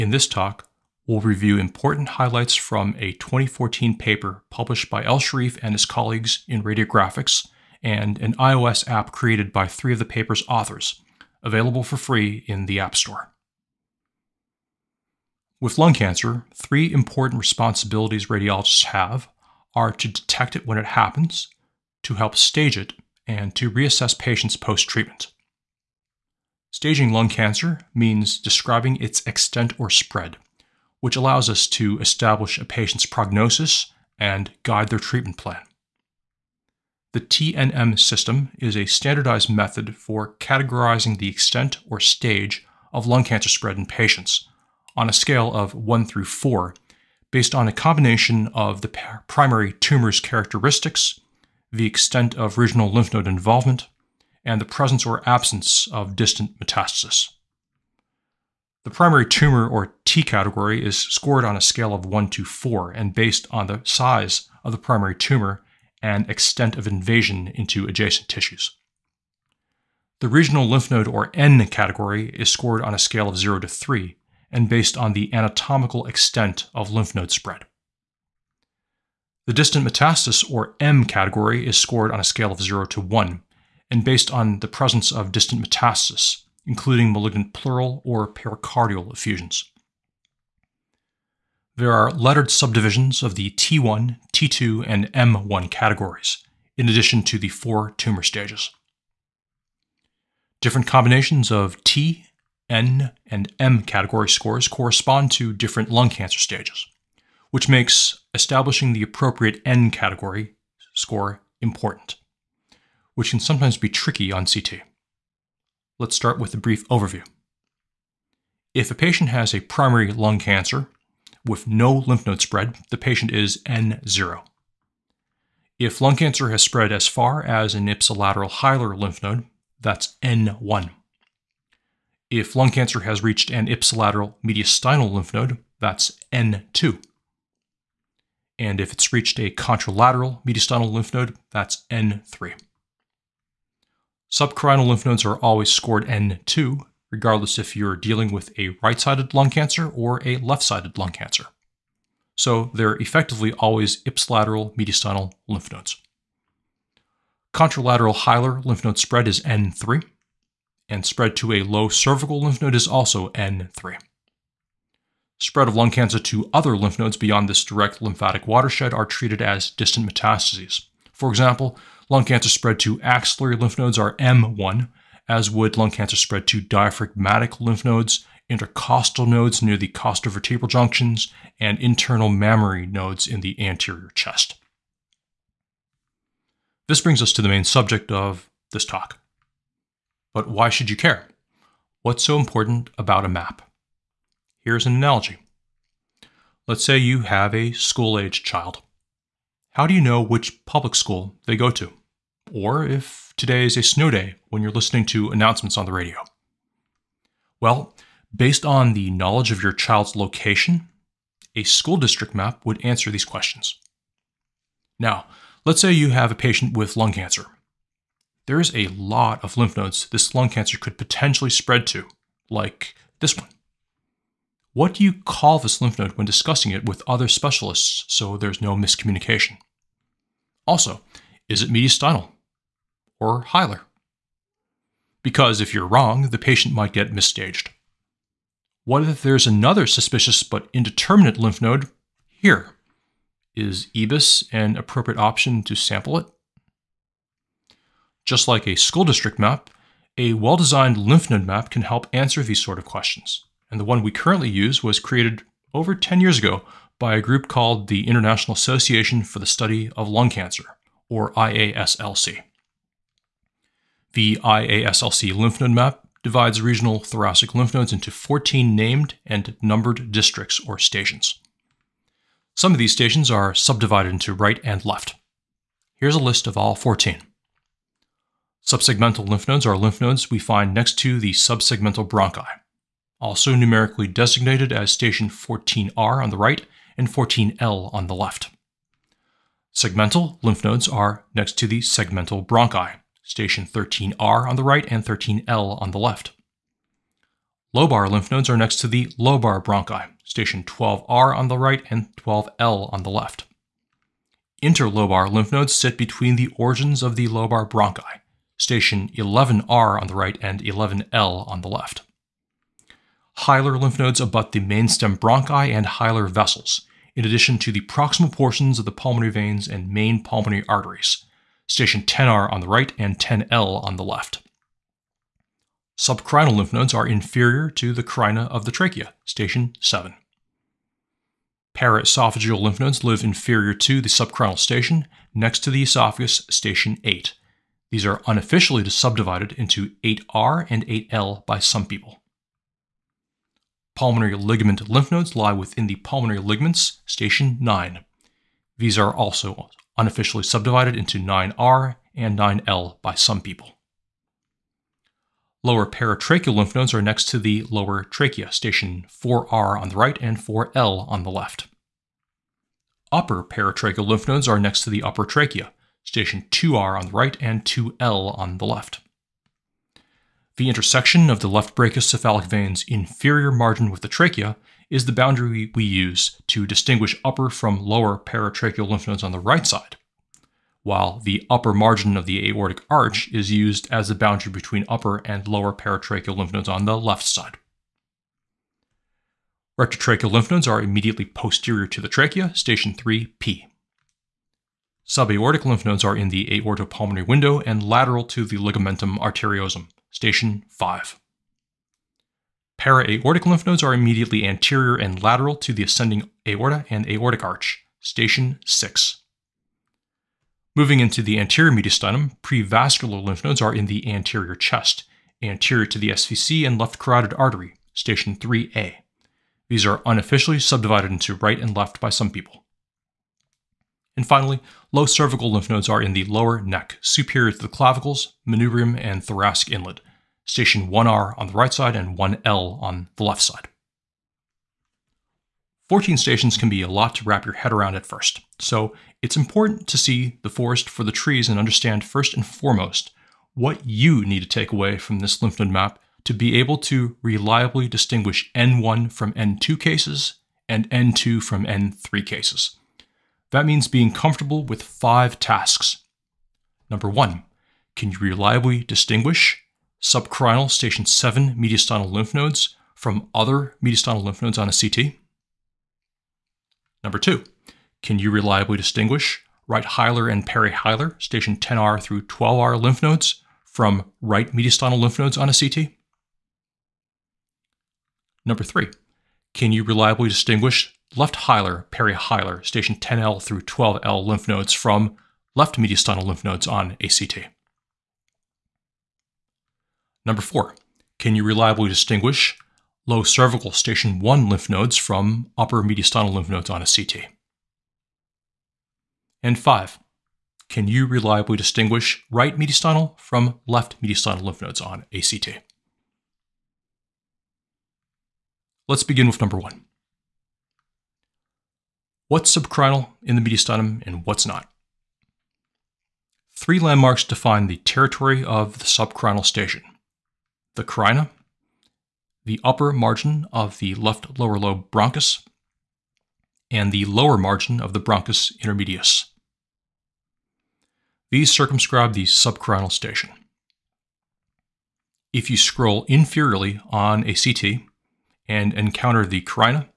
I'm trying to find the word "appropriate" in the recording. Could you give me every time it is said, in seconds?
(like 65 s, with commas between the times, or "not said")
109 s, 244 s.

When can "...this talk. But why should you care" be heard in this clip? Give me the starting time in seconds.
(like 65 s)
188 s.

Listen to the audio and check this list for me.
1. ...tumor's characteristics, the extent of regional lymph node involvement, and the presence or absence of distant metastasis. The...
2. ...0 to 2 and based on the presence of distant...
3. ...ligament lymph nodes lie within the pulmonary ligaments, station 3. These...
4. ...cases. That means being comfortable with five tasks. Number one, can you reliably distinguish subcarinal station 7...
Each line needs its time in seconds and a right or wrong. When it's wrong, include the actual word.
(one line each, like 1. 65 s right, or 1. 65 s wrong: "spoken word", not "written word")
1. 49 s right
2. 82 s wrong: "1", not "2"
3. 344 s wrong: "9", not "3"
4. 452 s right.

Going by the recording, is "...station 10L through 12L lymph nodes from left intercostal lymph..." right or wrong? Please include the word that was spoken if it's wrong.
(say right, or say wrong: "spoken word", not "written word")
wrong: "mediastinal", not "intercostal".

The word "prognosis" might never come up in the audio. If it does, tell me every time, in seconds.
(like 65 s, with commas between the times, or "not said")
33 s.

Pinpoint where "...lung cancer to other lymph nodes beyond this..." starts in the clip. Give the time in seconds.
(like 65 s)
165 s.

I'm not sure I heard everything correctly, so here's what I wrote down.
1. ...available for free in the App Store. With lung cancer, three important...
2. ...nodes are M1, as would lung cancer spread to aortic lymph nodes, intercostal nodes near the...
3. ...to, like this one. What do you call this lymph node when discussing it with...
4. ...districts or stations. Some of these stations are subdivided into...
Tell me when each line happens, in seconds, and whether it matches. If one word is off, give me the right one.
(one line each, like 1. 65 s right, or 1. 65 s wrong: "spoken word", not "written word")
1. 11 s right
2. 173 s wrong: "diaphragmatic", not "aortic"
3. 221 s right
4. 270 s right.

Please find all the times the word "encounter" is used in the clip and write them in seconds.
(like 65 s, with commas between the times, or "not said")
538 s.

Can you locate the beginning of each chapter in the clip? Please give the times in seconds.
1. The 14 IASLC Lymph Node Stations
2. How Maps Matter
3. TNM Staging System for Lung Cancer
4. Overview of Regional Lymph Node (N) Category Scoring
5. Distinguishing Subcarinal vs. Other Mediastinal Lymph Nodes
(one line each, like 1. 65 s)
1. 263 s
2. 189 s
3. 36 s
4. 108 s
5. 508 s.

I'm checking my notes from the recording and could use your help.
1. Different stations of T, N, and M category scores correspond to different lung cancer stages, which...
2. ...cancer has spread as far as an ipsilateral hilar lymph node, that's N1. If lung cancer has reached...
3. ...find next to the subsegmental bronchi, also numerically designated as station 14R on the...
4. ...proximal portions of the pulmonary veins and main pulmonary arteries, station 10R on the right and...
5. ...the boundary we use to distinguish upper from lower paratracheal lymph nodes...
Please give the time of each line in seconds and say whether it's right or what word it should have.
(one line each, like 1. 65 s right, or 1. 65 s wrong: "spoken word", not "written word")
1. 100 s wrong: "combinations", not "stations"
2. 126 s right
3. 280 s right
4. 317 s right
5. 375 s right.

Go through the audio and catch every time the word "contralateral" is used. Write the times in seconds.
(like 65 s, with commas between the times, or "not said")
139 s, 157 s.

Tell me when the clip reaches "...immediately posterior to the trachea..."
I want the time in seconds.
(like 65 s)
390 s.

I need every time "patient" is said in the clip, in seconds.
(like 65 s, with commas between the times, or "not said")
24 s, 32 s, 43 s, 118 s, 122 s, 216 s, 236 s.